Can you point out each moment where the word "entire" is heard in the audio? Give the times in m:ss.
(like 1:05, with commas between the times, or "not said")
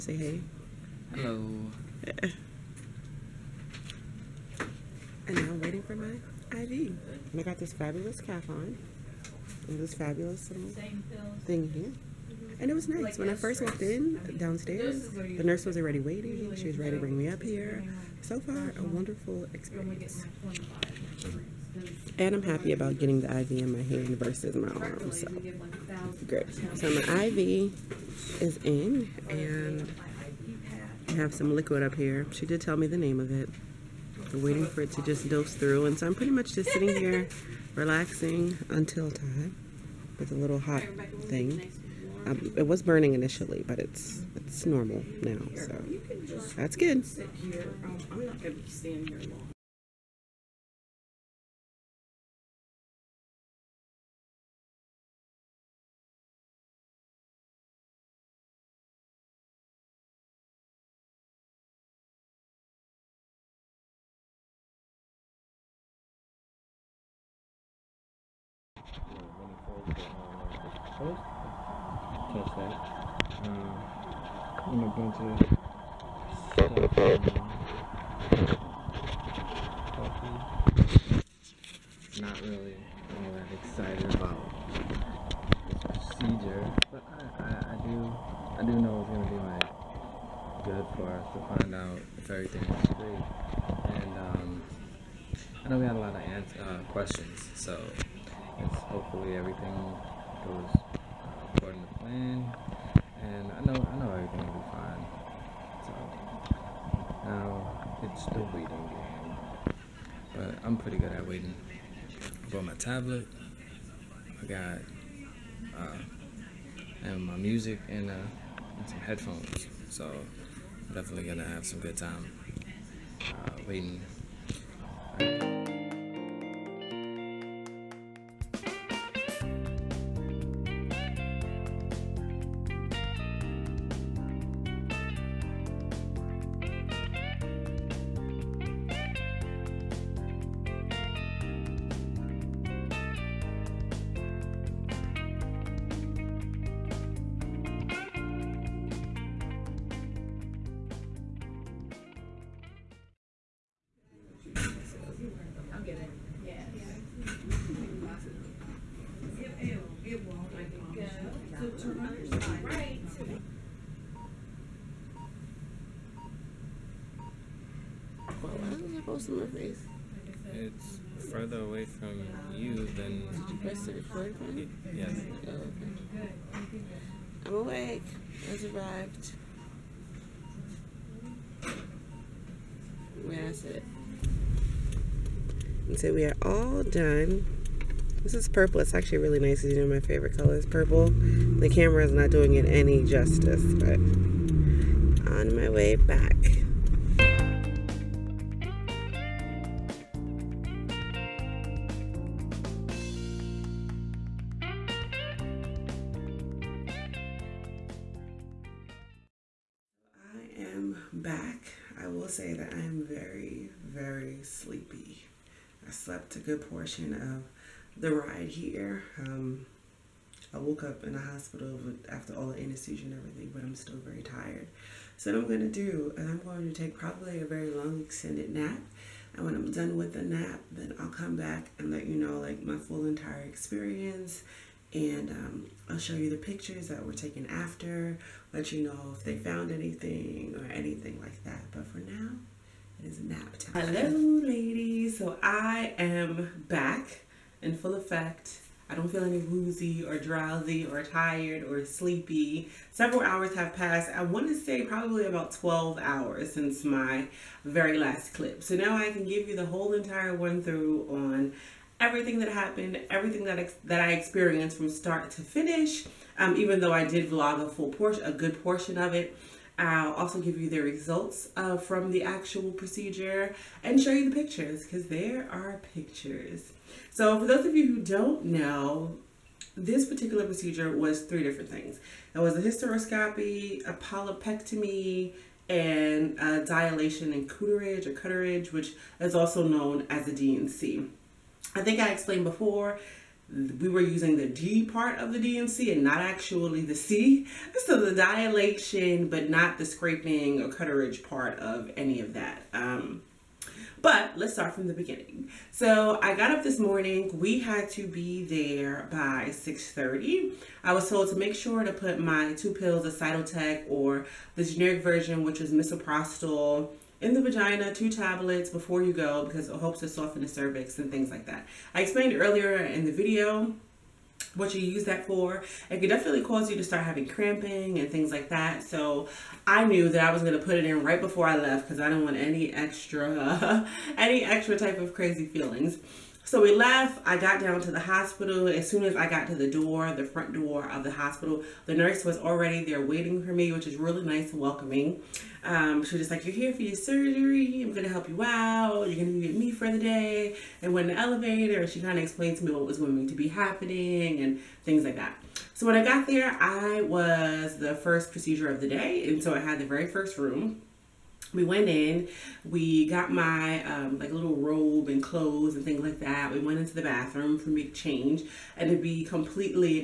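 3:53, 4:19.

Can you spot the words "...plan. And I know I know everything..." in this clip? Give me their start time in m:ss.
1:41.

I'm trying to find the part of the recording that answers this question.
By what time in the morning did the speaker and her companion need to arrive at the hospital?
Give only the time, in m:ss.
5:09.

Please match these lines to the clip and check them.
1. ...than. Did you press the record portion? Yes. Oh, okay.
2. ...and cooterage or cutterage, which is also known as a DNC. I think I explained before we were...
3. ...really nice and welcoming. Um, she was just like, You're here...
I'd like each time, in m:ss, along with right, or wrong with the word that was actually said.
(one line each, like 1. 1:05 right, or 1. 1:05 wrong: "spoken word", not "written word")
1. 2:52 wrong: "button", not "portion"
2. 4:47 right
3. 5:43 right.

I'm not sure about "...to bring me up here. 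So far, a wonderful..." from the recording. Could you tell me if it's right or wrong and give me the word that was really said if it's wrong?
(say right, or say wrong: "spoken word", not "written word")
right.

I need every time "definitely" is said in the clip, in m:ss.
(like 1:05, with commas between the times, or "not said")
2:00, 5:26.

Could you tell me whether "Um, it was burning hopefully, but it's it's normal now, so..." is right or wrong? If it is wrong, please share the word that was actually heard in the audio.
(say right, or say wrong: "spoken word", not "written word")
wrong: "initially", not "hopefully".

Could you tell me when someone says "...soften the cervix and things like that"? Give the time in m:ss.
5:20.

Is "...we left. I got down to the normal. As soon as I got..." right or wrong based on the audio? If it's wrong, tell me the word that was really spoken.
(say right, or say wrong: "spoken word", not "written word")
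wrong: "hospital", not "normal".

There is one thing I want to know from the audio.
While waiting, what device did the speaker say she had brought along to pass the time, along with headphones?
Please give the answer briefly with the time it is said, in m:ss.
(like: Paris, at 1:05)
tablet, at 1:52.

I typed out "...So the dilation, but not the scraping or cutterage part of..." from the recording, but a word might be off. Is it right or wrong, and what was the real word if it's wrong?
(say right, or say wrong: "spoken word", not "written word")
right.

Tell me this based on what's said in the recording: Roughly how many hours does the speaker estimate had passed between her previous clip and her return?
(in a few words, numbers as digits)
12.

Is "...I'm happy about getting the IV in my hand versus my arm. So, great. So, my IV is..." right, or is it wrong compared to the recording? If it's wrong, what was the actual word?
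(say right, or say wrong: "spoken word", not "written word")
right.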